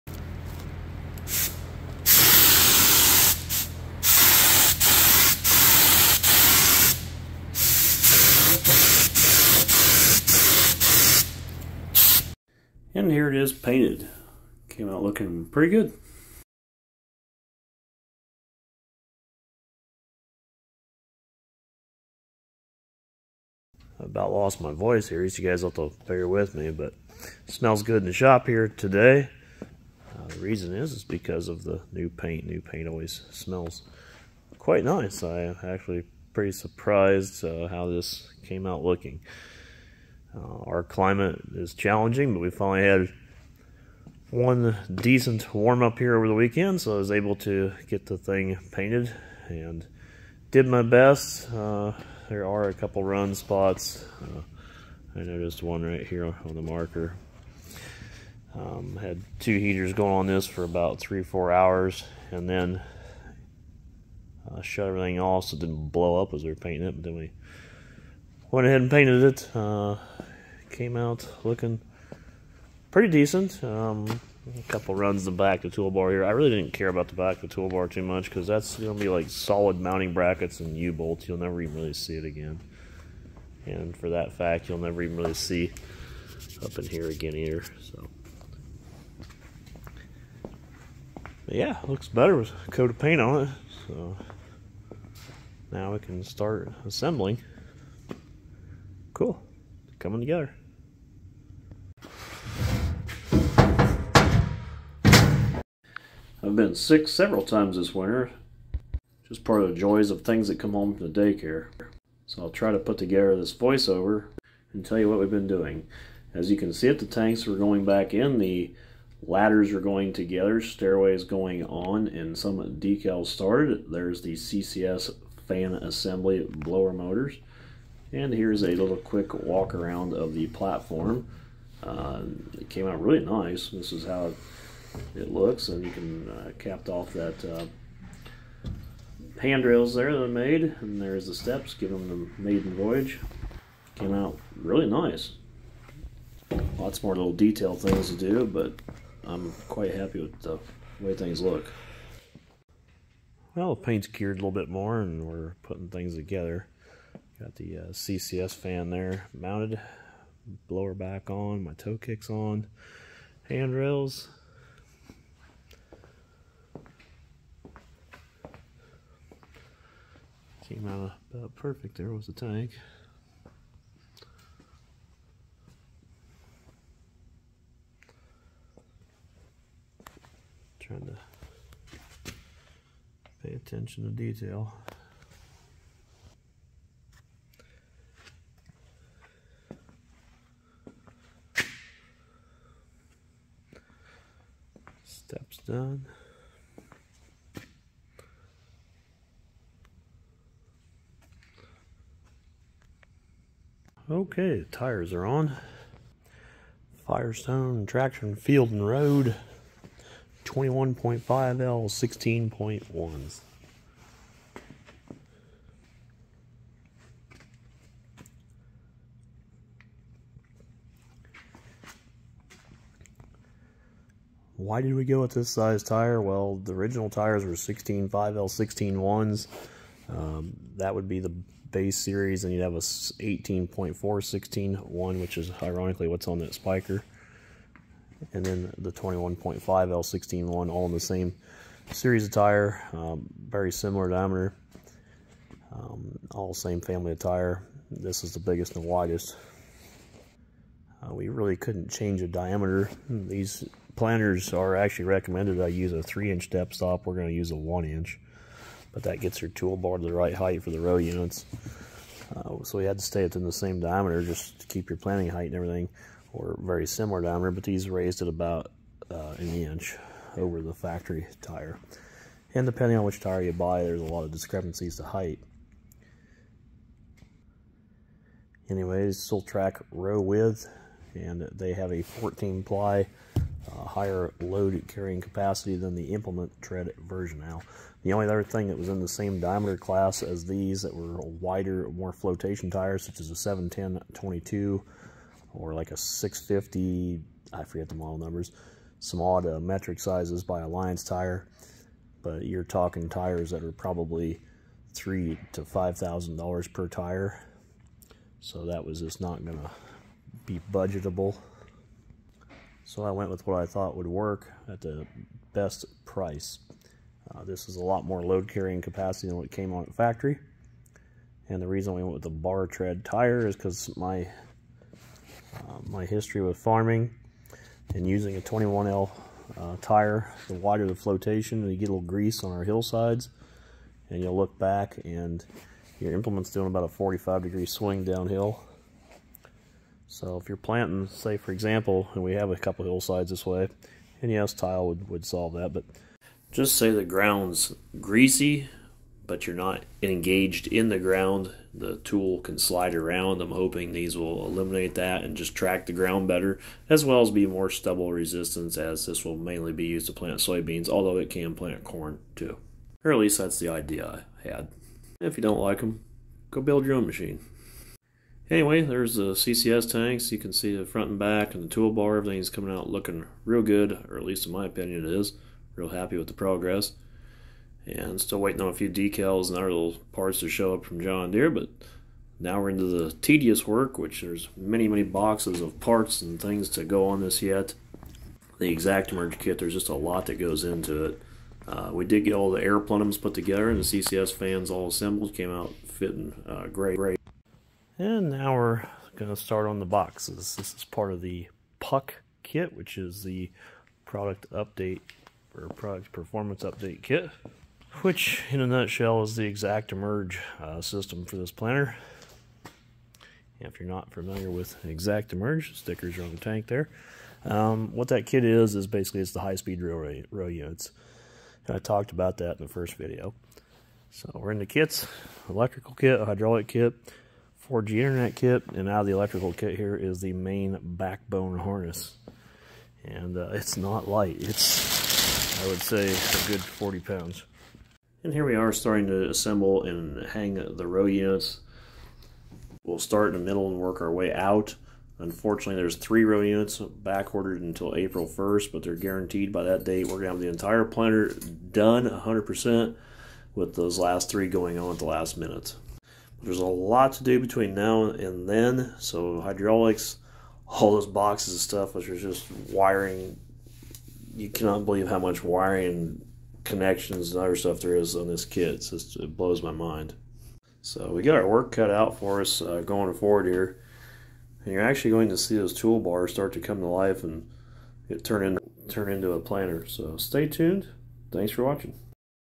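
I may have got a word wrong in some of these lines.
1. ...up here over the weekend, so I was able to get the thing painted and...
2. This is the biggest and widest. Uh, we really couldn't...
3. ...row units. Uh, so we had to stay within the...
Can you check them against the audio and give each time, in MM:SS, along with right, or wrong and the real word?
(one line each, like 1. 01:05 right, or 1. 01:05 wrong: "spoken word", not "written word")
1. 00:45 right
2. 04:07 right
3. 04:20 right.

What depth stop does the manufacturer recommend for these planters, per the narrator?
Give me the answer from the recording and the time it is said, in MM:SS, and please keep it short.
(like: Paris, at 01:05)
3 inch, at 04:16.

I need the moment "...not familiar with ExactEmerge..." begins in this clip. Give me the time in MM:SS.
06:53.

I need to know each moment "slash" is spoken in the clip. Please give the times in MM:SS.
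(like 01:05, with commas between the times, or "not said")
not said.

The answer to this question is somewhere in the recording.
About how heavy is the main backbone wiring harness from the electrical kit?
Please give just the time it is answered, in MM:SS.
07:16.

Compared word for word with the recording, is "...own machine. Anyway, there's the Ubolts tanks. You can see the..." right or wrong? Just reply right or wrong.
wrong.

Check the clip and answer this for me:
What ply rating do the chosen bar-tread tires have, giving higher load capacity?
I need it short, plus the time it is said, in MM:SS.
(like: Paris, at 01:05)
14 ply, at 04:42.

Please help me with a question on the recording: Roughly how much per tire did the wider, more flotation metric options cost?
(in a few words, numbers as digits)
3,000 to 5,000 dollars.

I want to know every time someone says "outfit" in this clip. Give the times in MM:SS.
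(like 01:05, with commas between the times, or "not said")
not said.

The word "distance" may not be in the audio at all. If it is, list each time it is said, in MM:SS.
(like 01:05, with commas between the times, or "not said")
not said.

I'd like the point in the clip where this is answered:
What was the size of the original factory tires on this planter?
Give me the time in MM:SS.
03:47.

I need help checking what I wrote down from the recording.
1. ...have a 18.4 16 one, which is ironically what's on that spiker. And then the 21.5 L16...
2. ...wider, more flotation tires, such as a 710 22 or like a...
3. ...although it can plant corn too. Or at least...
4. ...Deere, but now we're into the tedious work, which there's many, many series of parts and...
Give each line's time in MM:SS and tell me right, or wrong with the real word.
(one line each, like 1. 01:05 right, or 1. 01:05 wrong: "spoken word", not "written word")
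1. 03:52 right
2. 04:51 right
3. 06:00 right
4. 06:21 wrong: "boxes", not "series".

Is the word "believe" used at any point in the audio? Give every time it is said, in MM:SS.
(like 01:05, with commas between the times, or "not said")
07:44.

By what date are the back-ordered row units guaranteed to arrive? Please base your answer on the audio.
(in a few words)
April 1st.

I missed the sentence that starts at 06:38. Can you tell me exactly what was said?
And now we're going to start on the boxes.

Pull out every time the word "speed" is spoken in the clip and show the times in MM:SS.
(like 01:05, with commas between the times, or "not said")
06:59.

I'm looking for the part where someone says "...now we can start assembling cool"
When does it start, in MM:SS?
01:35.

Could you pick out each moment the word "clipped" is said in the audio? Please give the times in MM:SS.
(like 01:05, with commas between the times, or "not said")
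not said.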